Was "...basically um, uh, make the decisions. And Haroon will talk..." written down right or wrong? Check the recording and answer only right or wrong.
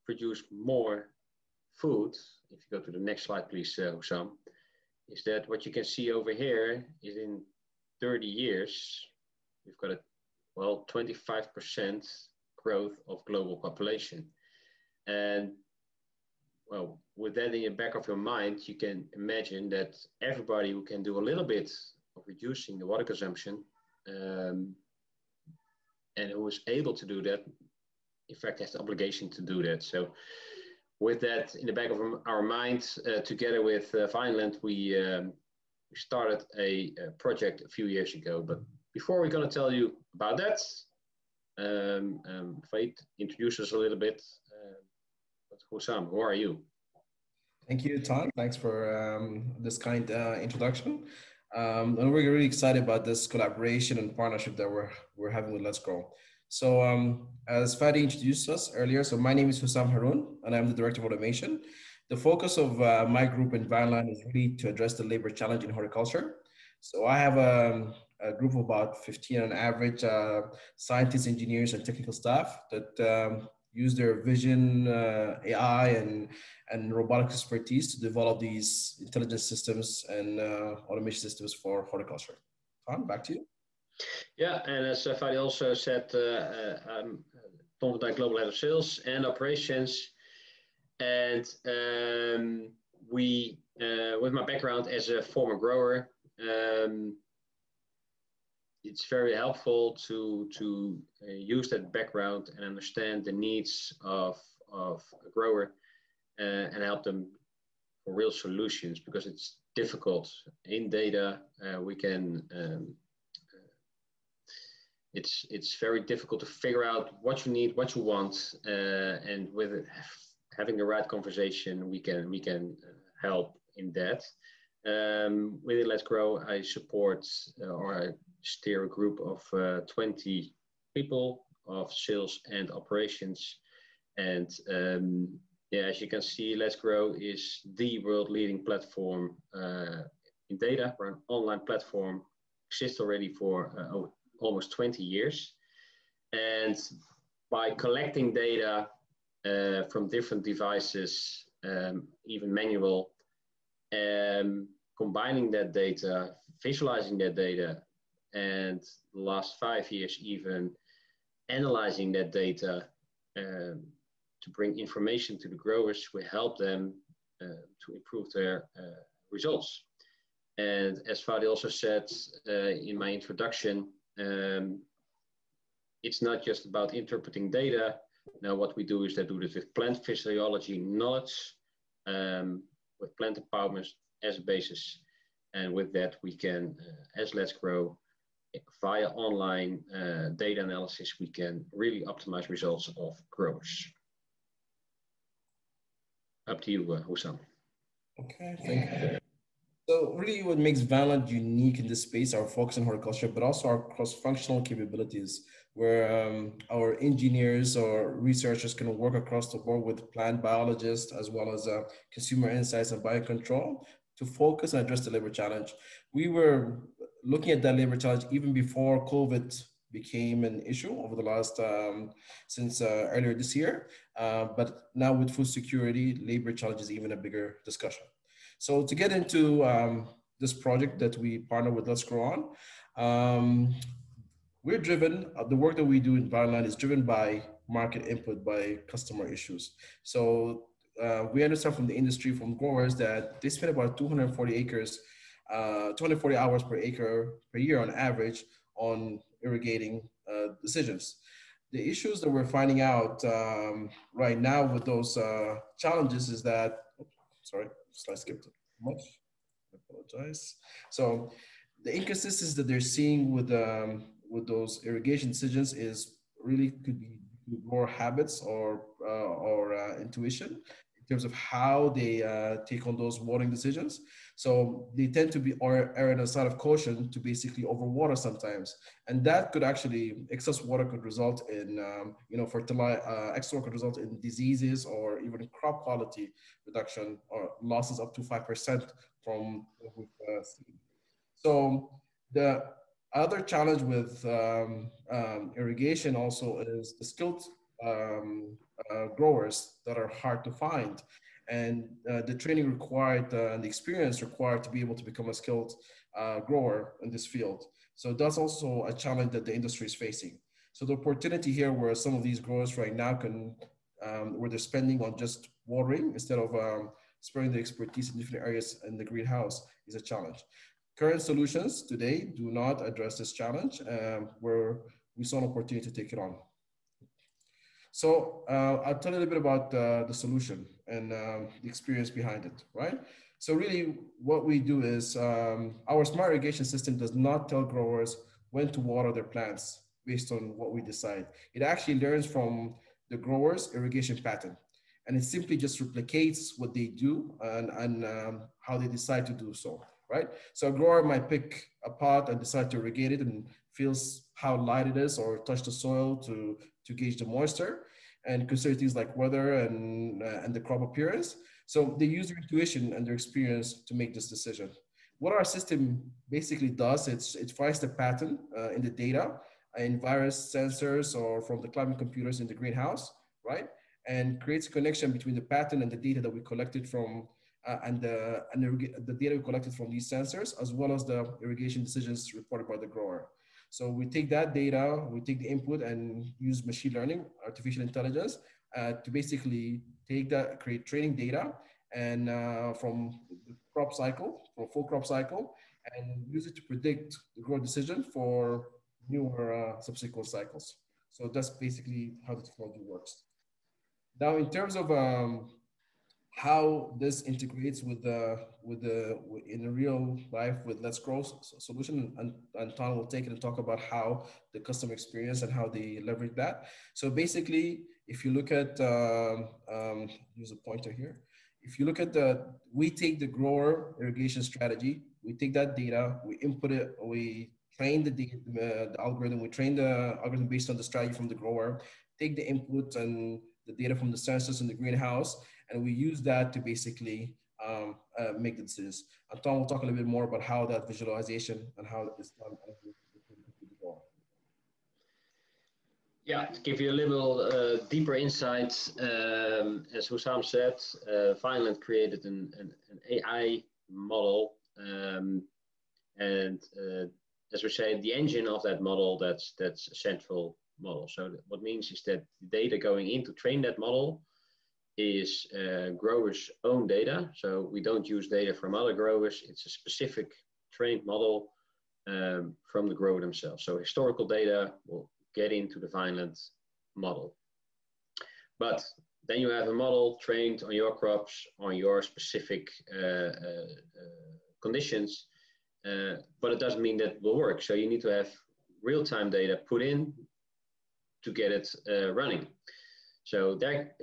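wrong.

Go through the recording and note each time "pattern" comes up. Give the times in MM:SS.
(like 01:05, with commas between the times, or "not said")
05:44, 06:07, 06:15.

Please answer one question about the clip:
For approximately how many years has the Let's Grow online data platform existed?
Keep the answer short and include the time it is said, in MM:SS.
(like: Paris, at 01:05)
almost 20 years, at 02:24.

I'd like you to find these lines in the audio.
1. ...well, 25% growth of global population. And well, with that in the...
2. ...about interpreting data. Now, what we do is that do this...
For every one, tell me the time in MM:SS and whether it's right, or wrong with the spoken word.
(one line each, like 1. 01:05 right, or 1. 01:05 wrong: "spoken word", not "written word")
1. 00:10 right
2. 02:56 right.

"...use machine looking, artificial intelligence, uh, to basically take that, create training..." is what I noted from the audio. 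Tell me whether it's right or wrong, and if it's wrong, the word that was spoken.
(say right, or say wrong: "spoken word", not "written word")
wrong: "learning", not "looking".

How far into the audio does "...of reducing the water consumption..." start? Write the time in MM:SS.
00:22.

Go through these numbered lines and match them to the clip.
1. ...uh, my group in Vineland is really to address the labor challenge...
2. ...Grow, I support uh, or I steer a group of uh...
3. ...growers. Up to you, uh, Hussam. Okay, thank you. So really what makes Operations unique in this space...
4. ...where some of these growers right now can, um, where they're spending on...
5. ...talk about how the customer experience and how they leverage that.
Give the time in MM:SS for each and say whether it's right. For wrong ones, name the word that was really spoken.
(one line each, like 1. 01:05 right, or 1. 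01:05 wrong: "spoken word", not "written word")
1. 01:02 right
2. 02:06 right
3. 03:13 wrong: "Vineland", not "Operations"
4. 05:11 right
5. 06:53 right.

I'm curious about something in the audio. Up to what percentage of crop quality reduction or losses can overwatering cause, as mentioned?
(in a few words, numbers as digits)
5%.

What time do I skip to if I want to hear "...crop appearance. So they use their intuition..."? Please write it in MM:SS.
06:00.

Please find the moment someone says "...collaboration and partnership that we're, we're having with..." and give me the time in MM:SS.
00:53.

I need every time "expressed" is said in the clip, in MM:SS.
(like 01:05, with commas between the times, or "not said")
not said.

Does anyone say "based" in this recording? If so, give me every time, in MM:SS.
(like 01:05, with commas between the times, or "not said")
05:40, 07:10.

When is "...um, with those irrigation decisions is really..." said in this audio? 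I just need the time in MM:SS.
04:23.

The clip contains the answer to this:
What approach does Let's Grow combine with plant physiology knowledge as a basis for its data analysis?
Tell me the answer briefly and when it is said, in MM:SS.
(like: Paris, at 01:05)
plant empowerment, at 03:03.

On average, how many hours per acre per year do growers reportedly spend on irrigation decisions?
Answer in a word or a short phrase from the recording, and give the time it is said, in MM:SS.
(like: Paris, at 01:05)
240, at 04:05.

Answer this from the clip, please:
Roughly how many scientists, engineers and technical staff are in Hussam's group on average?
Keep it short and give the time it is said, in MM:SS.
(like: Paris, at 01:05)
15, at 01:09.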